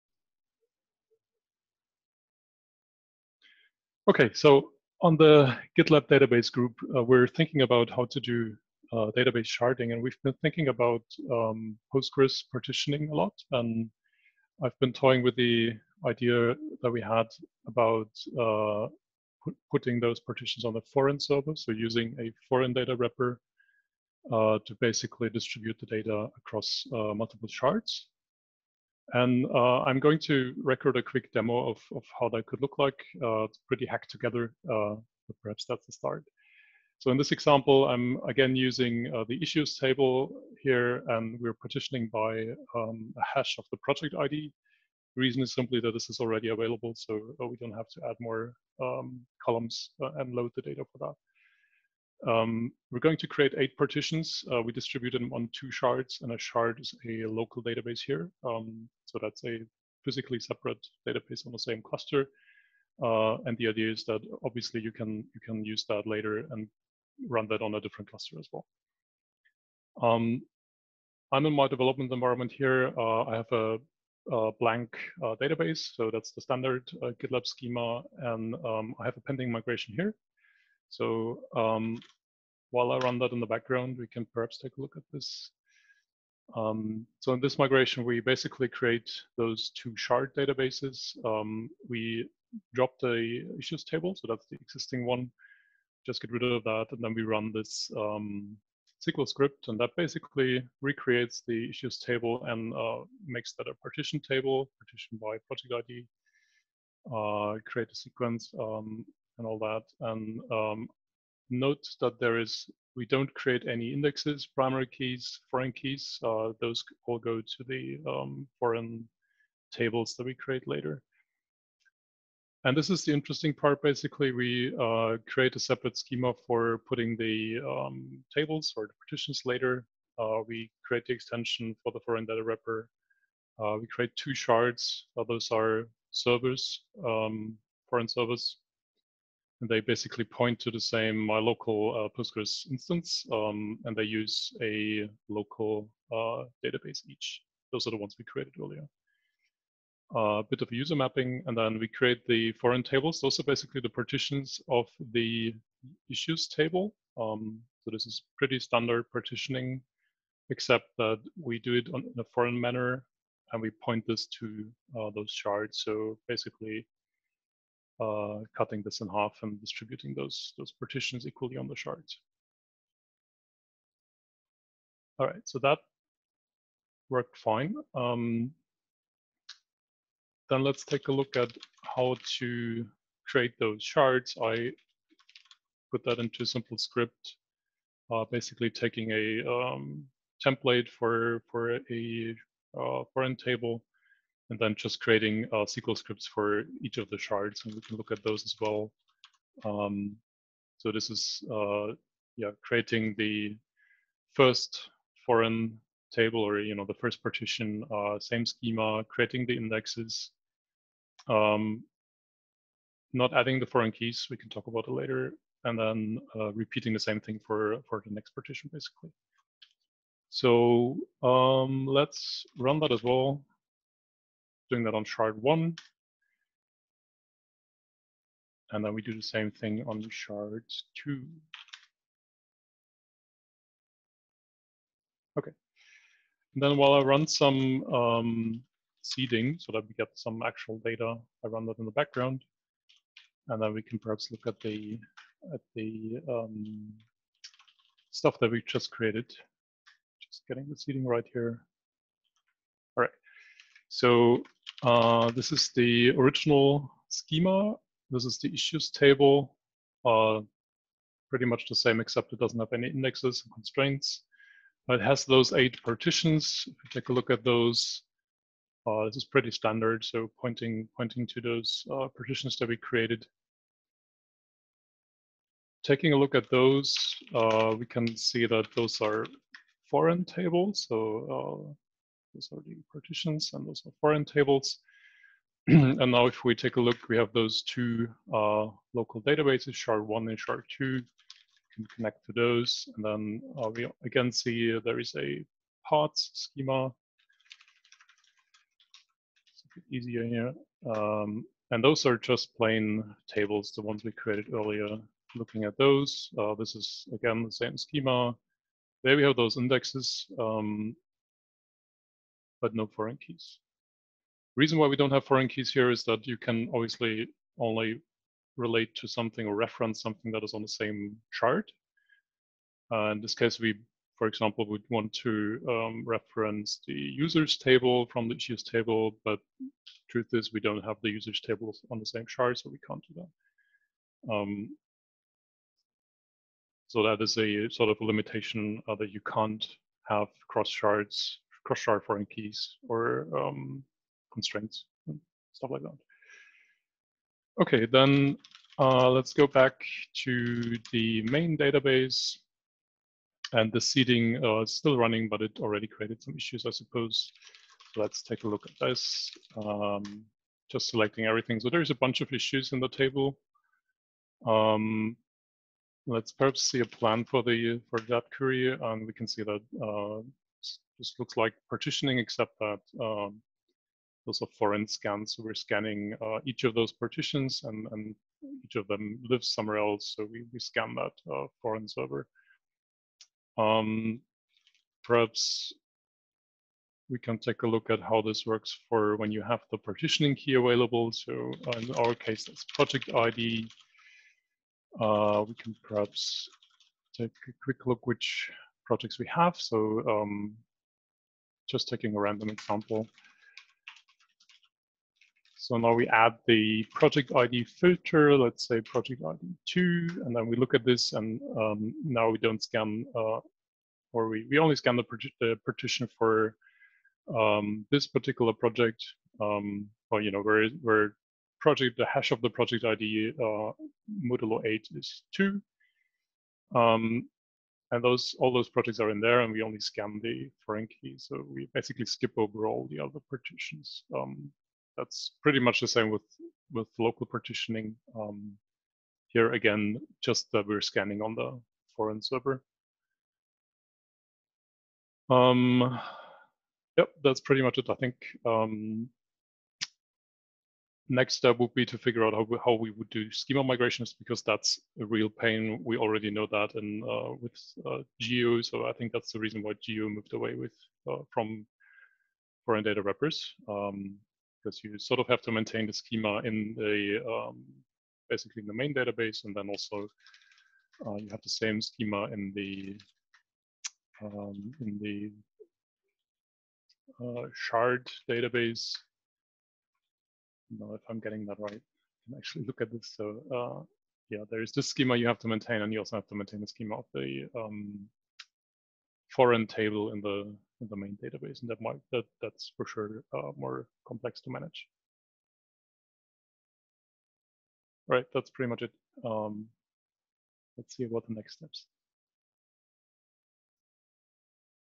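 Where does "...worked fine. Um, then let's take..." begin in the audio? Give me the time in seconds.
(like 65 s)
177 s.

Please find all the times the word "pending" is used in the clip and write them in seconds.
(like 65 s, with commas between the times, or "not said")
79 s.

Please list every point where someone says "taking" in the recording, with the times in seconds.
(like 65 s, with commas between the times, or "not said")
188 s, 275 s, 401 s.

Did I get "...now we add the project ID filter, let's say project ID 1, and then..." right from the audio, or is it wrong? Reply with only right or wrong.
wrong.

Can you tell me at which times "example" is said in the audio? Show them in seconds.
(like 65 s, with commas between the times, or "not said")
37 s, 324 s, 402 s.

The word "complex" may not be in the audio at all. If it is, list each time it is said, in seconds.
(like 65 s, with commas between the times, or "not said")
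494 s.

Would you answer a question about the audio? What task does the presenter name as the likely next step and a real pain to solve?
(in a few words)
schema migrations.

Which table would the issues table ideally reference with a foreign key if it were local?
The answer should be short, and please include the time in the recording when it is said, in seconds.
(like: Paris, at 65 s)
users table, at 326 s.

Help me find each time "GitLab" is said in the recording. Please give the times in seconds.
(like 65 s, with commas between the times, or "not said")
5 s, 77 s.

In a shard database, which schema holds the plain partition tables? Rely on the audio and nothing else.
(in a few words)
parts.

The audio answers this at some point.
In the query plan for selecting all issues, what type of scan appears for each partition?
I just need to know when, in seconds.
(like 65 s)
374 s.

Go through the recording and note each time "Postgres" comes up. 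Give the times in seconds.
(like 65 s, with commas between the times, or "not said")
11 s, 142 s.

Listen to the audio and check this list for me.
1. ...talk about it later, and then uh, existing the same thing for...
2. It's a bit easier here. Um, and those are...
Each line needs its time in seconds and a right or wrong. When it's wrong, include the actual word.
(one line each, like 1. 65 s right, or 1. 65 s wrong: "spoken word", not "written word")
1. 214 s wrong: "repeating", not "existing"
2. 299 s right.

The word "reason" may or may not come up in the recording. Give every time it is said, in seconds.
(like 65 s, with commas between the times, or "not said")
45 s, 314 s, 459 s.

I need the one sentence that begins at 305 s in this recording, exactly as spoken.
Looking at those, uh, this is again the same schema.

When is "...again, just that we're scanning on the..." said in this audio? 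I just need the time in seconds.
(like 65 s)
439 s.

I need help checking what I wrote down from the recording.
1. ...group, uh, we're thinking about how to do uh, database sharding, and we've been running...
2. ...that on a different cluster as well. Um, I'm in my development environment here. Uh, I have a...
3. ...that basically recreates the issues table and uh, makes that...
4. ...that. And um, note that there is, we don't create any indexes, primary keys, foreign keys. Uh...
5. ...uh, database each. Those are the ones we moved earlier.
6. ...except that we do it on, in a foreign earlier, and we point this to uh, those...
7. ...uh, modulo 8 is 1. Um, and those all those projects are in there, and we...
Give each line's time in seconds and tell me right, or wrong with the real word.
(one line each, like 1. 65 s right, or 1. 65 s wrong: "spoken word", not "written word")
1. 6 s wrong: "thinking", not "running"
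2. 67 s right
3. 99 s right
4. 109 s right
5. 146 s wrong: "created", not "moved"
6. 160 s wrong: "manner", not "earlier"
7. 423 s wrong: "2", not "1".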